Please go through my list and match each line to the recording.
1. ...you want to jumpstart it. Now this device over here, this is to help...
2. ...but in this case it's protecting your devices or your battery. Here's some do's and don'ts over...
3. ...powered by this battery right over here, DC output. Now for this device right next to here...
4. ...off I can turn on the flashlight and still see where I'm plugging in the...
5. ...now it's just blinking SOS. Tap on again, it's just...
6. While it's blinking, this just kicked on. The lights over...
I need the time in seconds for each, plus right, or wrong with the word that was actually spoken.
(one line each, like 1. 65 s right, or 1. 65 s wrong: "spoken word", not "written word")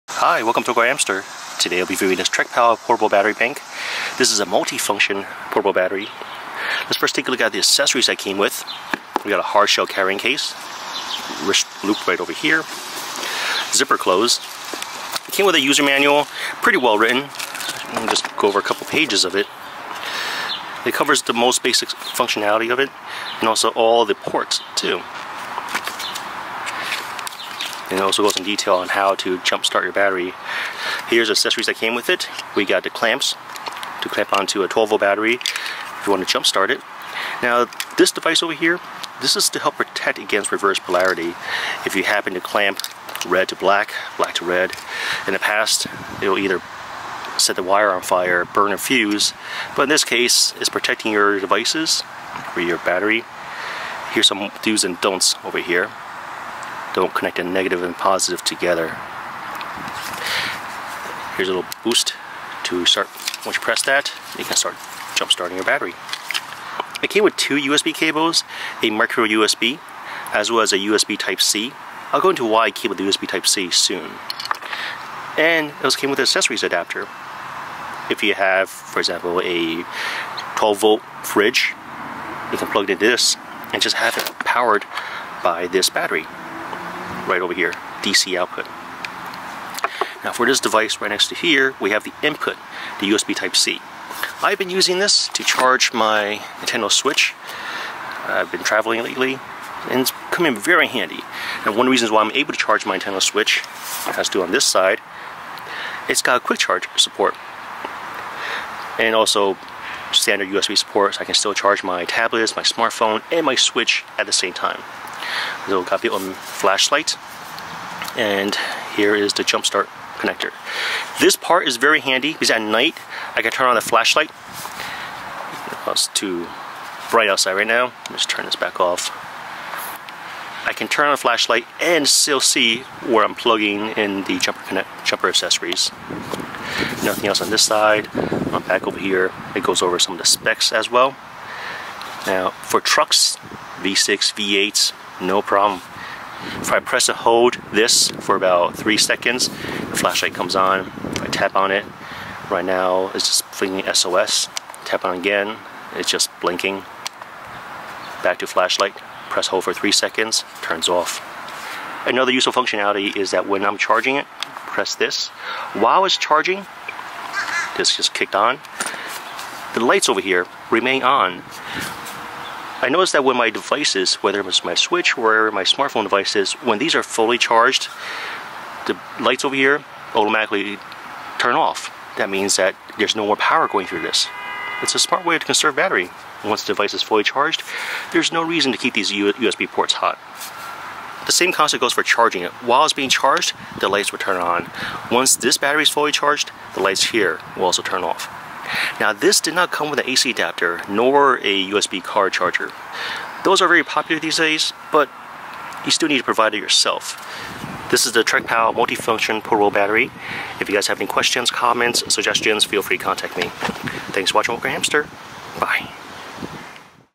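1. 36 s right
2. 49 s right
3. 84 s right
4. 128 s right
5. 152 s right
6. 165 s wrong: "charging", not "blinking".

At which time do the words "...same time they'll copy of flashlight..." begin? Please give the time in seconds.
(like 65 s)
114 s.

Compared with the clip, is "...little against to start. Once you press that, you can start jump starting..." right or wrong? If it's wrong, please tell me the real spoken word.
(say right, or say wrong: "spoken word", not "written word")
wrong: "boost", not "against".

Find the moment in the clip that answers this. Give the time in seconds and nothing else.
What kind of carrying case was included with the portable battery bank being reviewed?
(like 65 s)
9 s.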